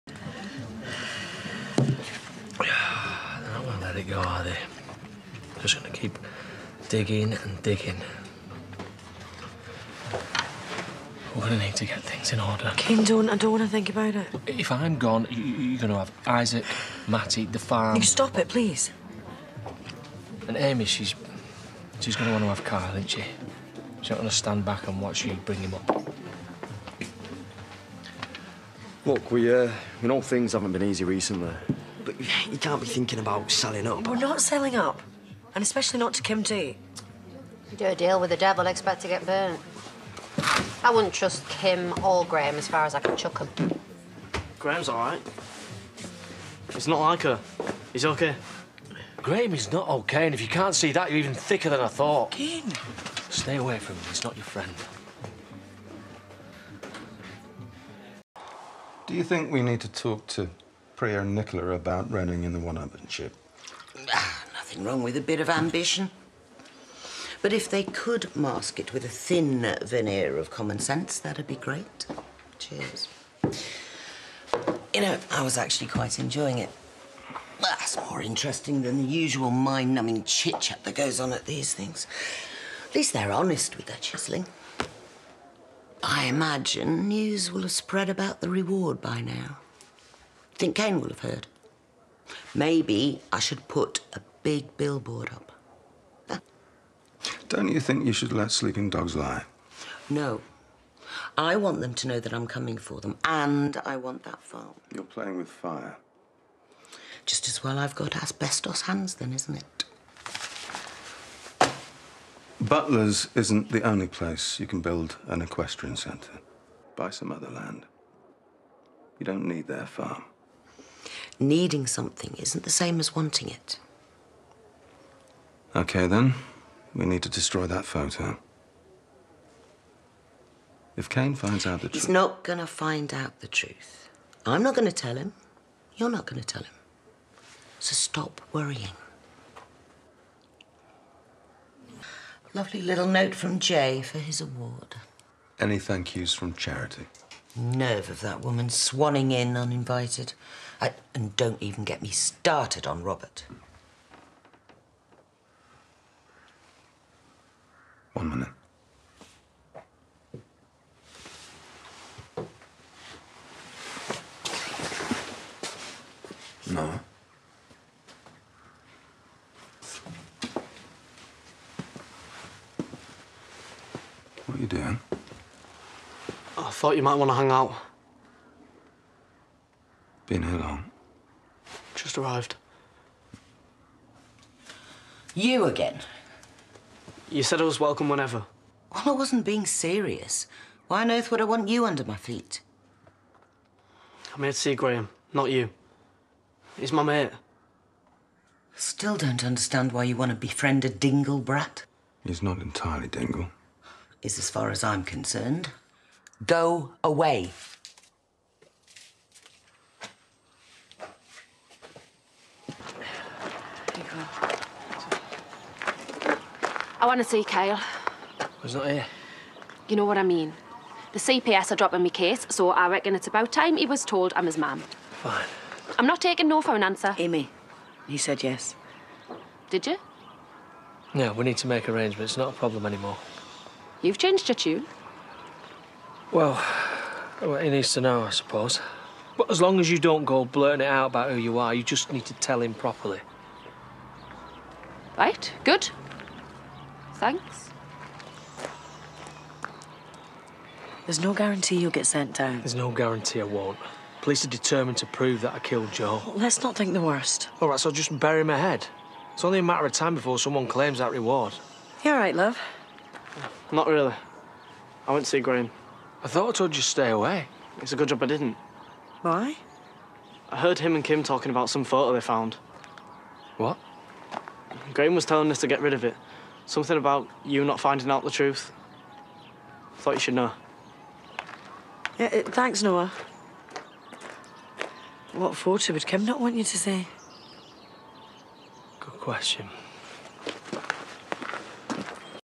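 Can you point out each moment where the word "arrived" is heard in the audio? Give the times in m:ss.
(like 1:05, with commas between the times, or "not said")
3:02.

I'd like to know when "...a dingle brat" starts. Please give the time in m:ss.
3:20.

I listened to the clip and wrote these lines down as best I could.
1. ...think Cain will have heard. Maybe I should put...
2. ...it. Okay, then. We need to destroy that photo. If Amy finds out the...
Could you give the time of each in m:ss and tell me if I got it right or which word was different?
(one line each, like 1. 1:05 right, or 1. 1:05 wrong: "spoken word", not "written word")
1. 1:30 right
2. 2:03 wrong: "Cain", not "Amy".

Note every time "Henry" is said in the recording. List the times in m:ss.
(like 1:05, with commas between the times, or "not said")
not said.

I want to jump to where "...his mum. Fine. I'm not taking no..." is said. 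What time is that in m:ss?
3:44.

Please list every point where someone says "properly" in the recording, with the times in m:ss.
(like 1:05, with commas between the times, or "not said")
4:02.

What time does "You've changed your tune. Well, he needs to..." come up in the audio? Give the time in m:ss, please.
3:54.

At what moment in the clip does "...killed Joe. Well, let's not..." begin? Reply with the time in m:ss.
4:15.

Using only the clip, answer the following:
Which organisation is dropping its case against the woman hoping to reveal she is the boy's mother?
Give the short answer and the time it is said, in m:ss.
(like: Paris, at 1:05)
CPS, at 3:41.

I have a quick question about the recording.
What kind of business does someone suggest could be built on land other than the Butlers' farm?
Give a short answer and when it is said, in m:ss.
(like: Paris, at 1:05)
Equestrian centre, at 1:55.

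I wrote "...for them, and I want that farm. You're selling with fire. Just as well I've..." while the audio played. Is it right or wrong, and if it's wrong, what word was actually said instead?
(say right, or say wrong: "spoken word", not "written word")
wrong: "playing", not "selling".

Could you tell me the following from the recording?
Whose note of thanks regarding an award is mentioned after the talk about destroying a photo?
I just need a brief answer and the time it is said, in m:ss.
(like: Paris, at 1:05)
Jai, at 2:23.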